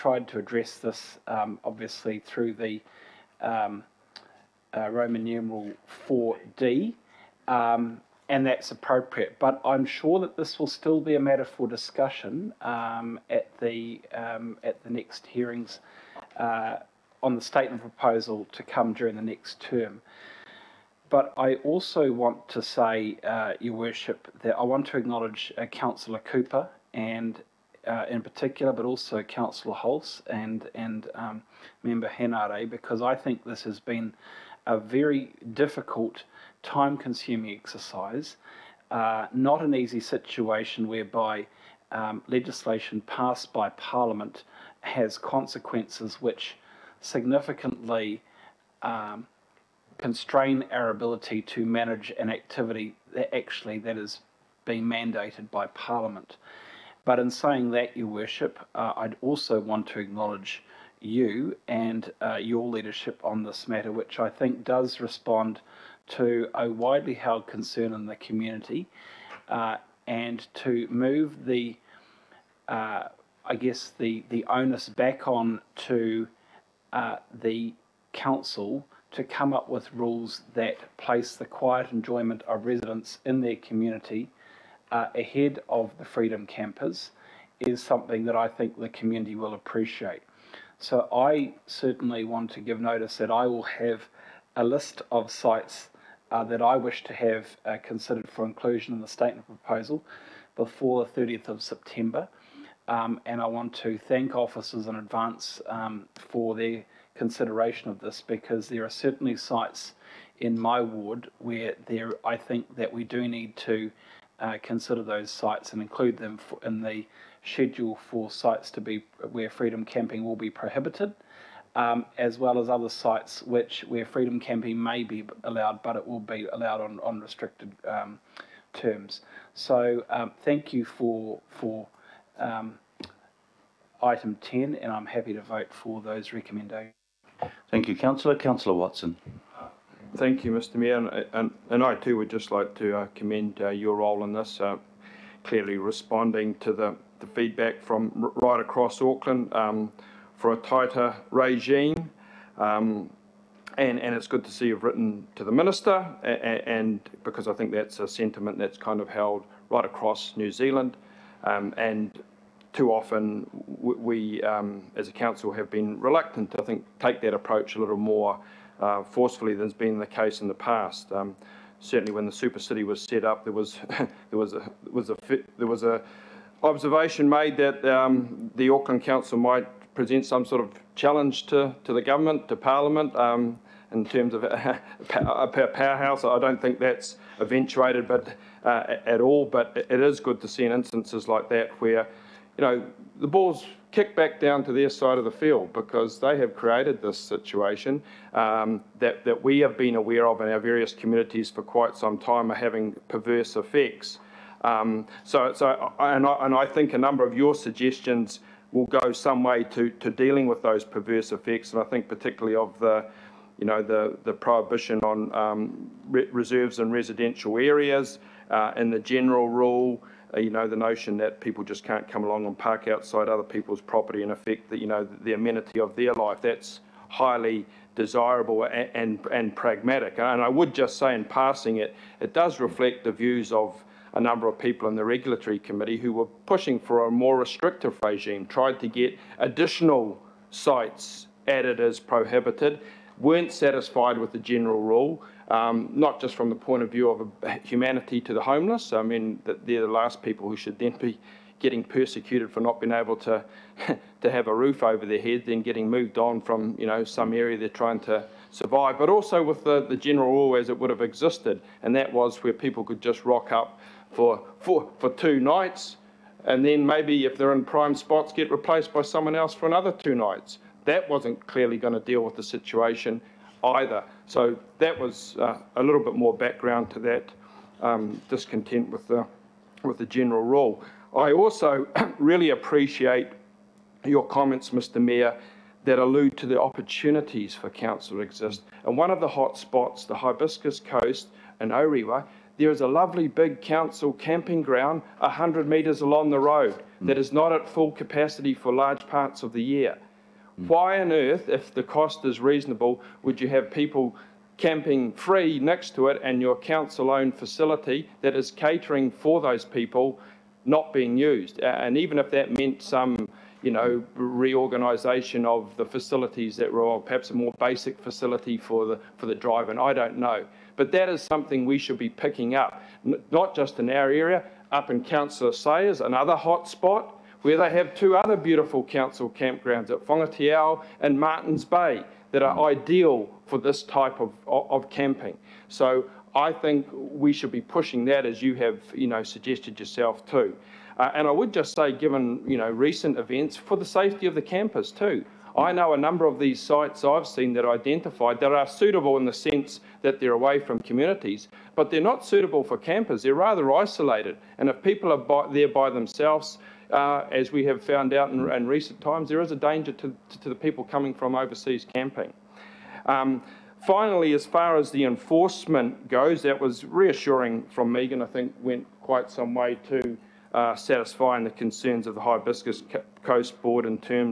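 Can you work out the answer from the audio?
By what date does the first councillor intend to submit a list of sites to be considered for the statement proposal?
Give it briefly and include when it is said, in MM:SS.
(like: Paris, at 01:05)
30 September, at 01:41.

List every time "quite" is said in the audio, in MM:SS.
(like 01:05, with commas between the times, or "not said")
03:21, 06:09.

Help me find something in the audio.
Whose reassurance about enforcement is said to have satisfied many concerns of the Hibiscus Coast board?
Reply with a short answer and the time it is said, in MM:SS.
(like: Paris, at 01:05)
Megan, at 06:07.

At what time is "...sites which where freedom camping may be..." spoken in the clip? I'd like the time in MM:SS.
02:02.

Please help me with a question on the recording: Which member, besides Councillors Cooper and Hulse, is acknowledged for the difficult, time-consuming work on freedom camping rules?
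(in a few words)
Henare.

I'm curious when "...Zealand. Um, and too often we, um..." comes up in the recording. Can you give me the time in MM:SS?
02:40.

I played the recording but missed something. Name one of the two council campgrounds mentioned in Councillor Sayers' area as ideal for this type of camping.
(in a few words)
Whangateau.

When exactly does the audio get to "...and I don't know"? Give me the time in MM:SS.
05:19.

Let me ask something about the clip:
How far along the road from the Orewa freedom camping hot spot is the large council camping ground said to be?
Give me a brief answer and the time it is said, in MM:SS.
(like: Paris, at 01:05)
100 metres, at 04:55.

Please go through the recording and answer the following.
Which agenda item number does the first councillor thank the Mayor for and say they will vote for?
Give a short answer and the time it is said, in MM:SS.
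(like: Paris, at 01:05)
10, at 02:14.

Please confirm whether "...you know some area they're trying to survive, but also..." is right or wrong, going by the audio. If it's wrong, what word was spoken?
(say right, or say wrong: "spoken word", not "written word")
right.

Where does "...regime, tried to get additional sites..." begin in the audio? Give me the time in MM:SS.
03:58.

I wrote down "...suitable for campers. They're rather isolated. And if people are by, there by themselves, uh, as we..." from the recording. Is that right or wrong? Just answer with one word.
right.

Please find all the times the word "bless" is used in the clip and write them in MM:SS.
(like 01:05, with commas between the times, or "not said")
not said.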